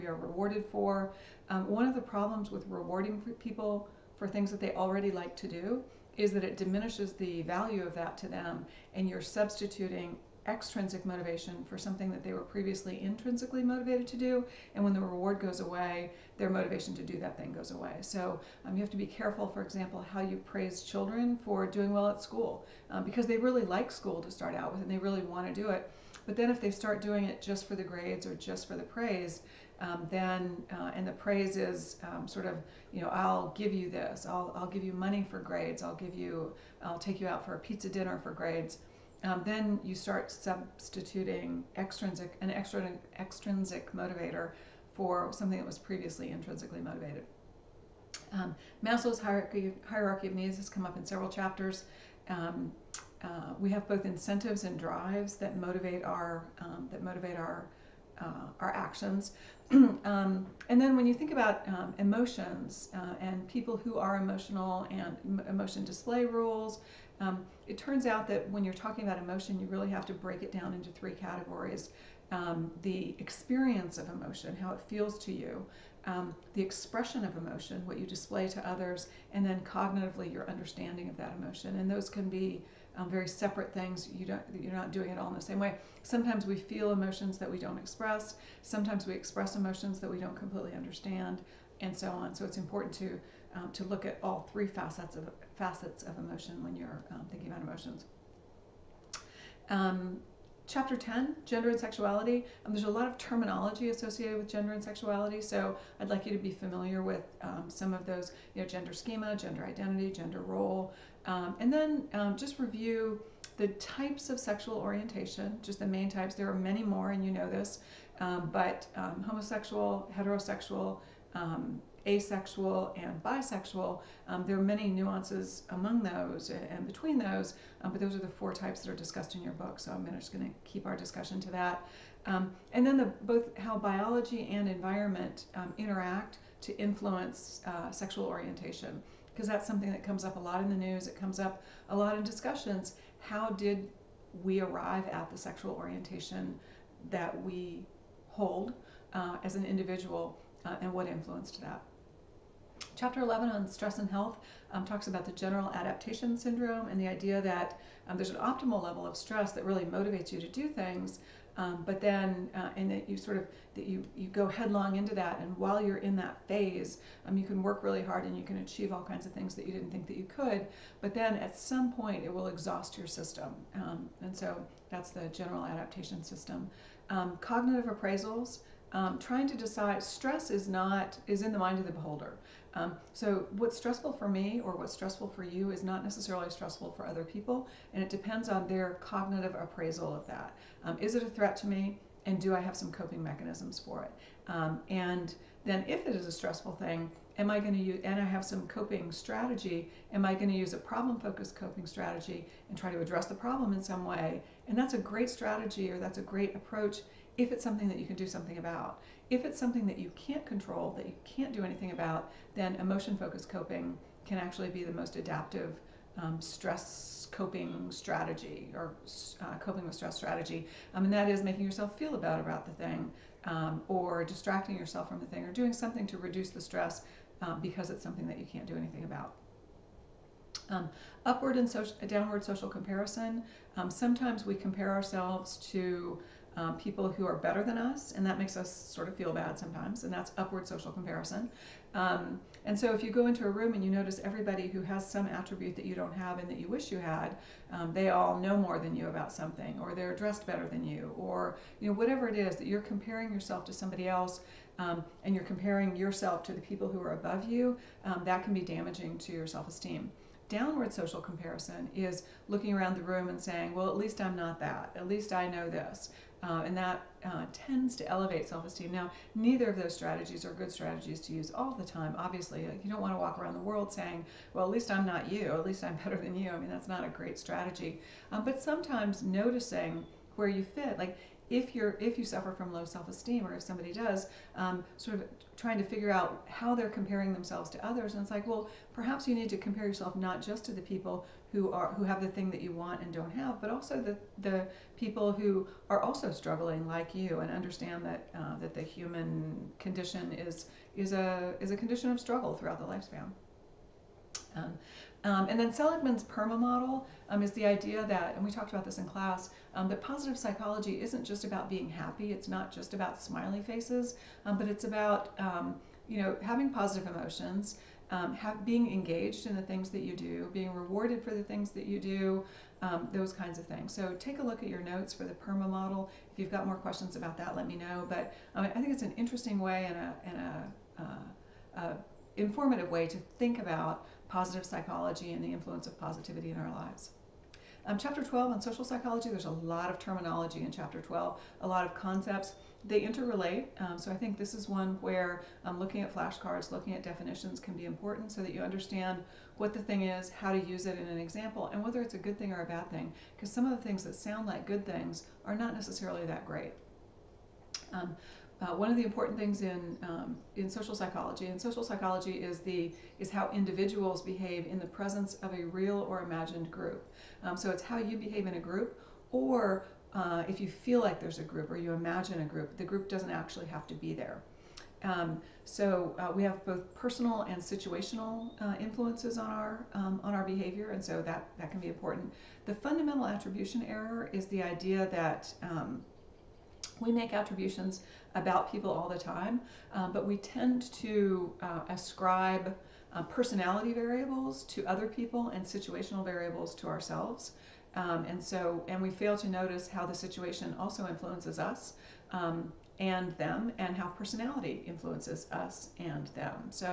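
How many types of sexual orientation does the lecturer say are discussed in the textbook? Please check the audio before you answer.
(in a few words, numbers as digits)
4.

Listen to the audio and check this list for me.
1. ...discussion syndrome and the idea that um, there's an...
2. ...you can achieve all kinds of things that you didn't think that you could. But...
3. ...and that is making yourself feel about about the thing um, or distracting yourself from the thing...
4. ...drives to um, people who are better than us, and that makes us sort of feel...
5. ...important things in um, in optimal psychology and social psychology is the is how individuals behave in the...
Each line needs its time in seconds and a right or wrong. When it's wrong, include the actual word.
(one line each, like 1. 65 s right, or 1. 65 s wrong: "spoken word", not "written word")
1. 155 s wrong: "adaptation", not "discussion"
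2. 168 s right
3. 221 s right
4. 234 s wrong: "ourselves", not "drives"
5. 359 s wrong: "social", not "optimal".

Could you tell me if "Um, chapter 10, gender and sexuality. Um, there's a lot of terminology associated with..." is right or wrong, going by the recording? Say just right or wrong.
right.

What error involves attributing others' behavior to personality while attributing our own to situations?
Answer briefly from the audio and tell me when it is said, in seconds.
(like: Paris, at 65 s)
fundamental attribution error, at 382 s.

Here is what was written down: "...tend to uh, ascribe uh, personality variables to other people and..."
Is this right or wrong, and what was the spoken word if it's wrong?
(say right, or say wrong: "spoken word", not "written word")
right.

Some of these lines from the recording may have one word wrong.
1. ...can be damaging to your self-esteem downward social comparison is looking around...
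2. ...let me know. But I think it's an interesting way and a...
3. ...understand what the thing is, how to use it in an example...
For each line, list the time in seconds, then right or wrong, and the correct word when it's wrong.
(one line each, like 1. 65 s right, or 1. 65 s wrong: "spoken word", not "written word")
1. 258 s right
2. 327 s right
3. 348 s right.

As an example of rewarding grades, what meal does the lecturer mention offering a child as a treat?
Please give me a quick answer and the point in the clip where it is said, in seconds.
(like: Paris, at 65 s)
pizza dinner, at 37 s.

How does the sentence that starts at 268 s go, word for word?
Now, neither of those strategies are good strategies to use all the time.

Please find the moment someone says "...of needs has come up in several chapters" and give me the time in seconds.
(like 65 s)
50 s.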